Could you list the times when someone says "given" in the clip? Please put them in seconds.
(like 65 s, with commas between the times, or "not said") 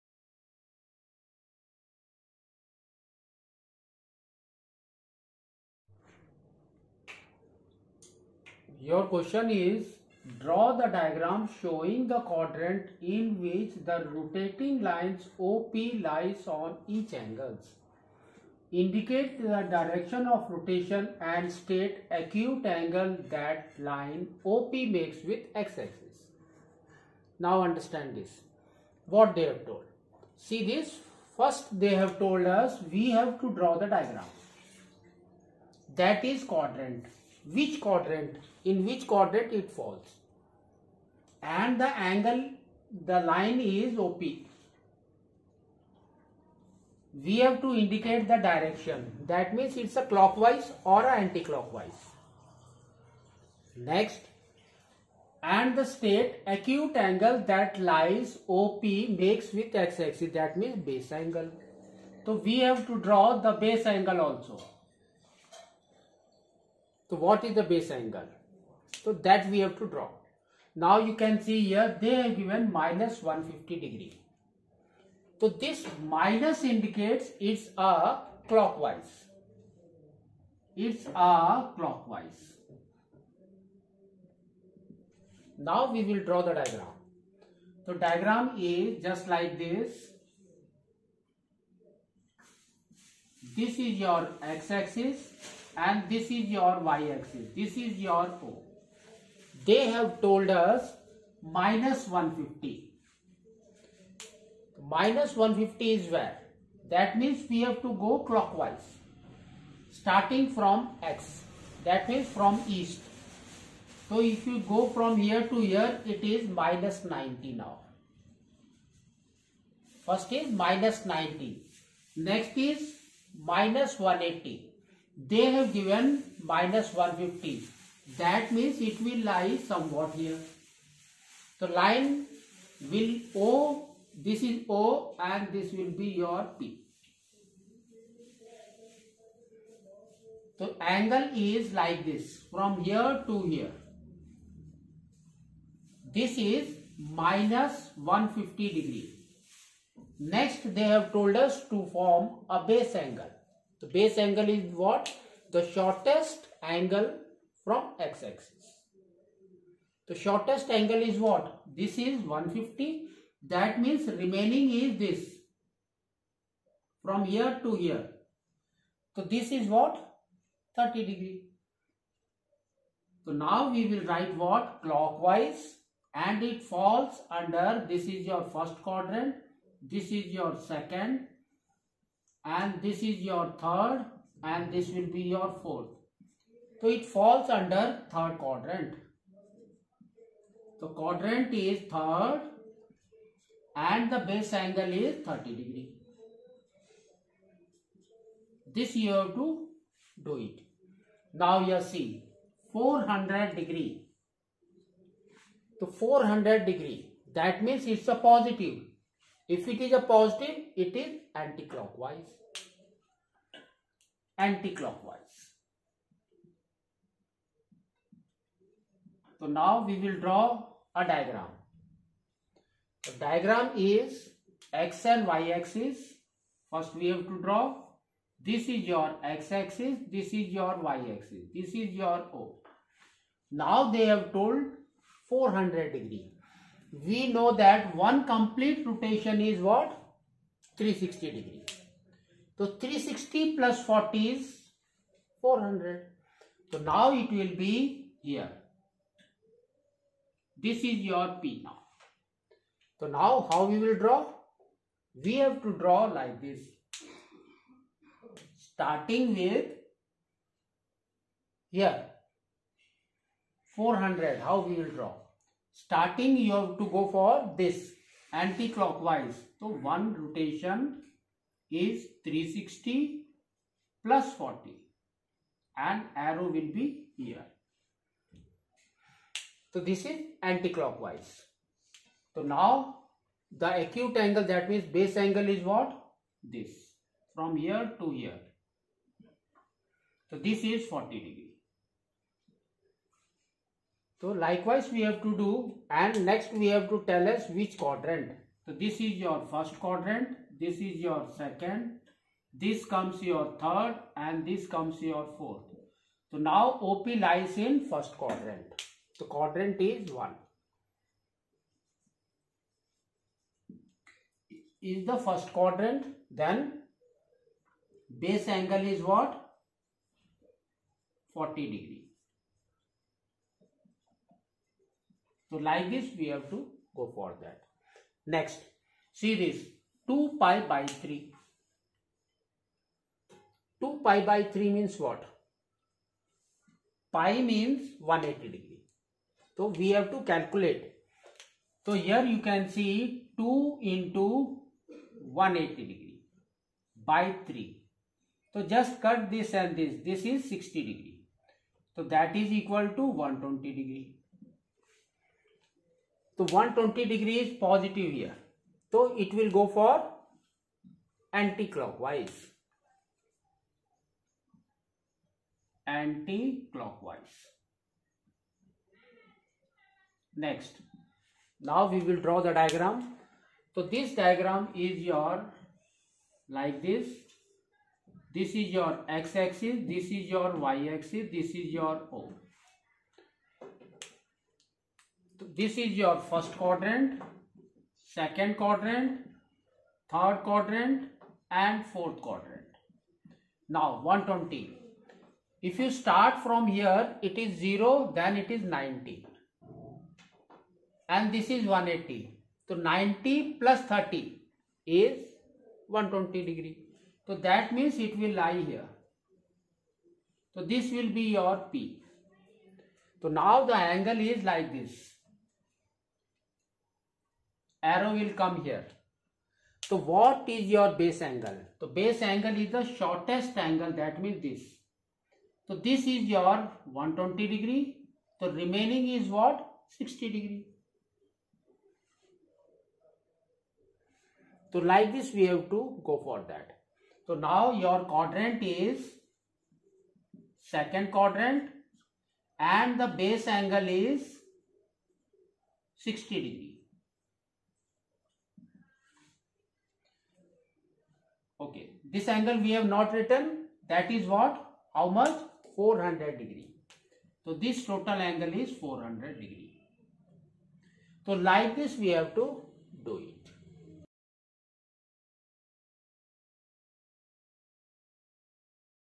72 s, 125 s.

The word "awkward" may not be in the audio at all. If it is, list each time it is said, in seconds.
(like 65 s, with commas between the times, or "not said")
not said.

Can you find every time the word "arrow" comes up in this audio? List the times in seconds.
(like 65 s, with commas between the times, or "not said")
276 s, 417 s.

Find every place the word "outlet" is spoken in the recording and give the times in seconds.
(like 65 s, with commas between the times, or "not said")
not said.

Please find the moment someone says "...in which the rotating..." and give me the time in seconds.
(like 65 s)
13 s.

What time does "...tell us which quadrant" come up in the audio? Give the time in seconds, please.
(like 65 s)
297 s.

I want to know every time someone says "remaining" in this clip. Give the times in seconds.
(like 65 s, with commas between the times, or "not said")
164 s, 428 s.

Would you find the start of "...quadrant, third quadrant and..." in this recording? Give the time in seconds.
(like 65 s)
388 s.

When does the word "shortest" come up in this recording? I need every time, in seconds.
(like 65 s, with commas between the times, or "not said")
155 s, 160 s, 422 s.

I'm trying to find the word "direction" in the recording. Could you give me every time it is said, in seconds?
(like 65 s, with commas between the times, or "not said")
19 s, 48 s.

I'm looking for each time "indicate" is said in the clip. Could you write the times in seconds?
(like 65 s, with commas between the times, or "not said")
18 s, 47 s, 76 s.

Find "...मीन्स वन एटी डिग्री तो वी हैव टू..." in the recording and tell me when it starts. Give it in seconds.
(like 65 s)
337 s.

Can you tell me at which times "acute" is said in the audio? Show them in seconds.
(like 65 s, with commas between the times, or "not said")
22 s, 56 s, 283 s.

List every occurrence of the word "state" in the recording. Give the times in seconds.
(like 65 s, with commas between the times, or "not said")
21 s, 55 s.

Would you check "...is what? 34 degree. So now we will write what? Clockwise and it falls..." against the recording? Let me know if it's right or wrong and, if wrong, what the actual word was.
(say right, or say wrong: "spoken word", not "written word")
wrong: "30", not "34".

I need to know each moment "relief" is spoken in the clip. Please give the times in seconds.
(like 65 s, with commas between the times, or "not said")
not said.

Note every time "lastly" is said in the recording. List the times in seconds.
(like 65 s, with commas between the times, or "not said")
not said.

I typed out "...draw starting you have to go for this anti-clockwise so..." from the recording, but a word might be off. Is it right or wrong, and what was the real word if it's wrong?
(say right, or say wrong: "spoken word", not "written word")
right.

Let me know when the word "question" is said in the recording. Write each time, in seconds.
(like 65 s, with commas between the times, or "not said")
9 s.